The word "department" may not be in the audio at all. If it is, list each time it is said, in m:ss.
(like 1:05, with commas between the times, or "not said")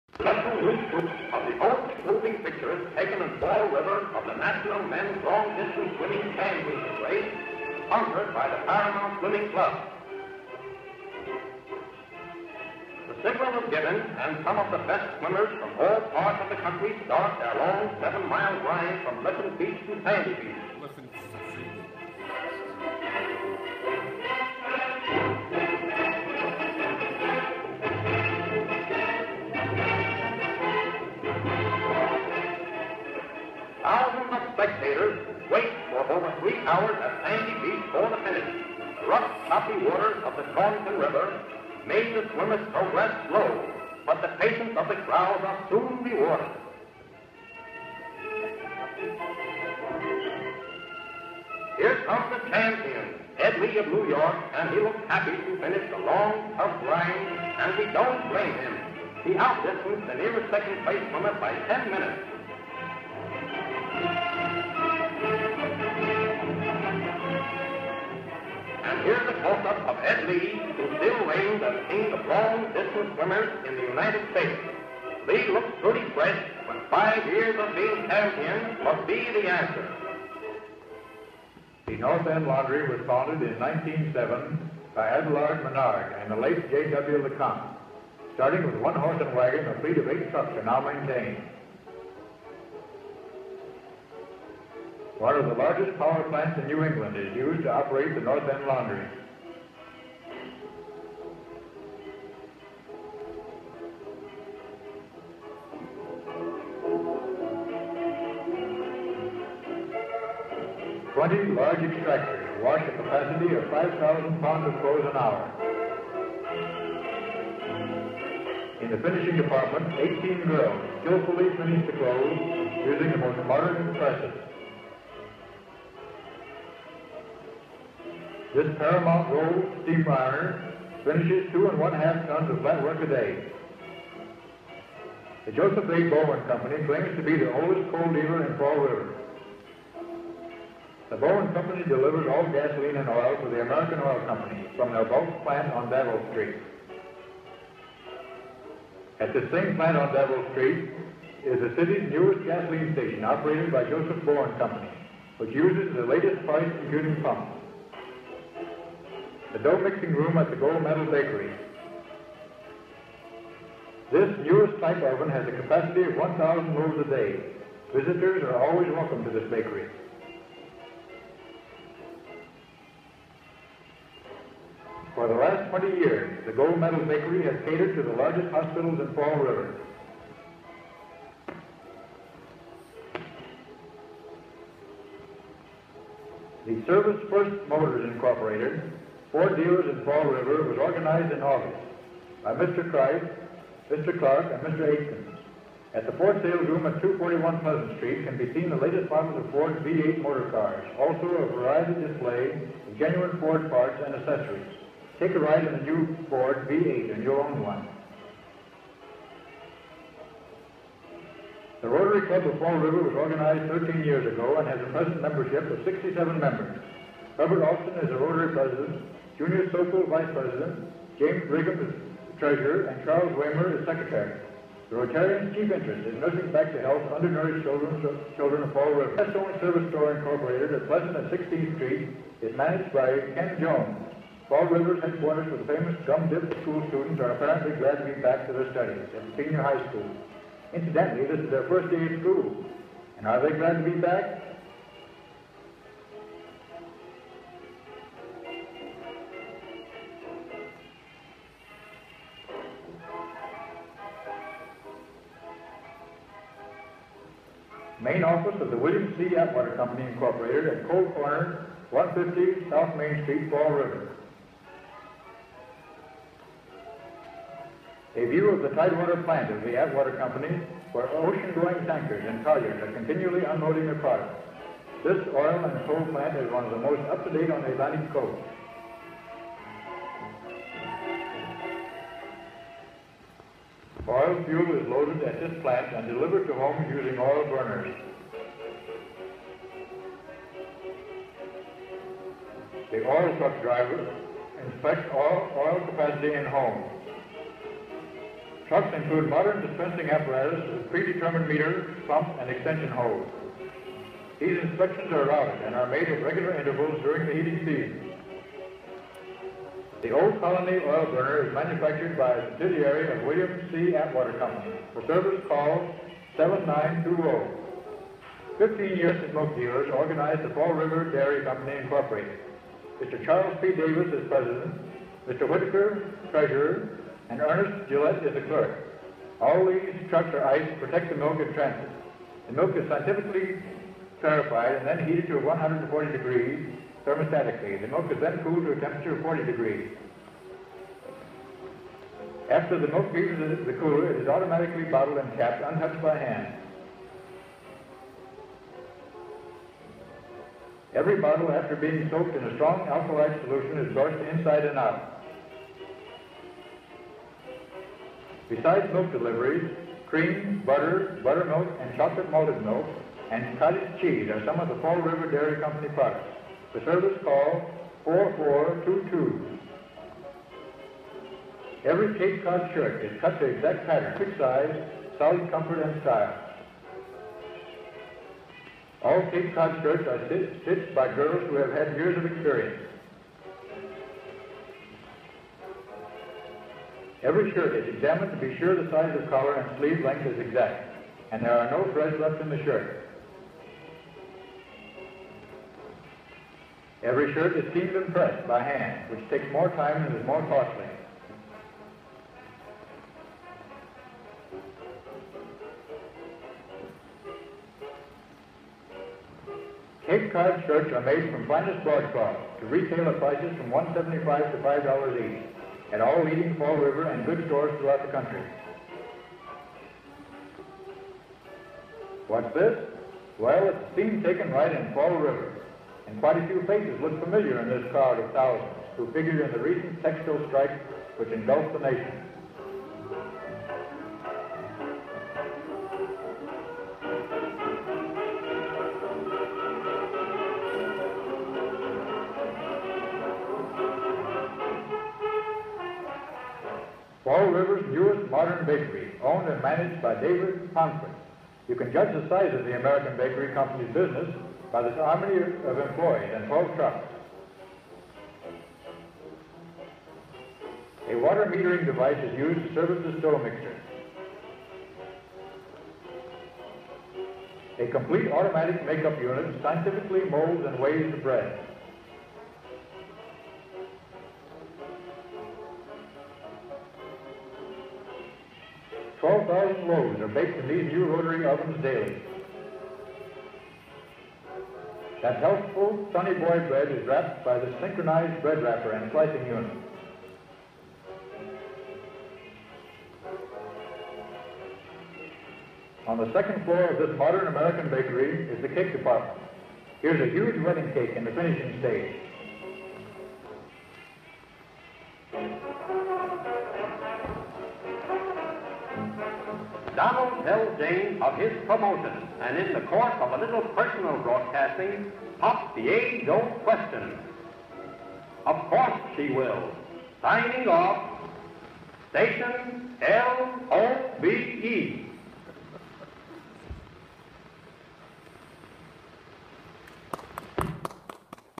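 1:59, 8:18.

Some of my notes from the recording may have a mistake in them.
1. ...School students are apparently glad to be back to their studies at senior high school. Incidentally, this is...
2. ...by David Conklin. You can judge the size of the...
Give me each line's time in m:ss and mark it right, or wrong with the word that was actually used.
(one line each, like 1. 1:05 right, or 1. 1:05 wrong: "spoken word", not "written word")
1. 3:56 right
2. 7:30 right.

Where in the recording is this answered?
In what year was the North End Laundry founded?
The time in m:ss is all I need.
1:23.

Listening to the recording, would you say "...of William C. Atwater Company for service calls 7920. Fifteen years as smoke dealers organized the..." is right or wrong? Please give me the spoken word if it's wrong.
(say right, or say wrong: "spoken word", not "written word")
right.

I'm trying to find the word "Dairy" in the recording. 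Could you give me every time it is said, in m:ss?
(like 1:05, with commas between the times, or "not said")
5:21, 6:05.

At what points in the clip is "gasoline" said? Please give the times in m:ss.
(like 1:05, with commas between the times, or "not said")
2:22, 2:32.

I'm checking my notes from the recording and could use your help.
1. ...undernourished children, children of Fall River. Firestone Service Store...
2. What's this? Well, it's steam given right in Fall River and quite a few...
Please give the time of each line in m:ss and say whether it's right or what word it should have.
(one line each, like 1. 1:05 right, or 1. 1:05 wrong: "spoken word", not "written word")
1. 3:47 right
2. 7:02 wrong: "taken", not "given".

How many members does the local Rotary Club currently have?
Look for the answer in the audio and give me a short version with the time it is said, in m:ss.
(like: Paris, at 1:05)
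67, at 3:35.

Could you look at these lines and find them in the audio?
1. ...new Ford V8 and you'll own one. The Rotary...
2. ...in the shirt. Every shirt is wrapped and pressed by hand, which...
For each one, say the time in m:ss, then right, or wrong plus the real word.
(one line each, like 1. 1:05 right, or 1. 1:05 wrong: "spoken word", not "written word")
1. 3:25 right
2. 6:32 wrong: "seamed", not "wrapped".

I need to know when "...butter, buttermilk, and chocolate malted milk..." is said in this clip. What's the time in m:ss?
6:00.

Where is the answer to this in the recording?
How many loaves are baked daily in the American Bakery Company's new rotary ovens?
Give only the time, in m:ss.
7:59.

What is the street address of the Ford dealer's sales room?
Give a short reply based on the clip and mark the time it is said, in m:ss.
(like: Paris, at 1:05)
241 Pleasant Street, at 3:17.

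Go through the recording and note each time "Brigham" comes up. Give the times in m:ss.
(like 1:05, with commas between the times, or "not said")
3:41.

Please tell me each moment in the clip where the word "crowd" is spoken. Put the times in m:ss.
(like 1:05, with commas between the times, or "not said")
0:45, 7:07.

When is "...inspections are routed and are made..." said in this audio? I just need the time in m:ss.
5:04.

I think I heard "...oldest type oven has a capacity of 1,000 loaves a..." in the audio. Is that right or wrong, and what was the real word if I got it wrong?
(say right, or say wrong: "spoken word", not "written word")
wrong: "newest", not "oldest".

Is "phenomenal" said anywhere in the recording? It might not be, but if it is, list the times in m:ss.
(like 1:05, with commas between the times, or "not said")
not said.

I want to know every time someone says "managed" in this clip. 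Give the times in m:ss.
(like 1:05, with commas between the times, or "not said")
3:52, 7:29.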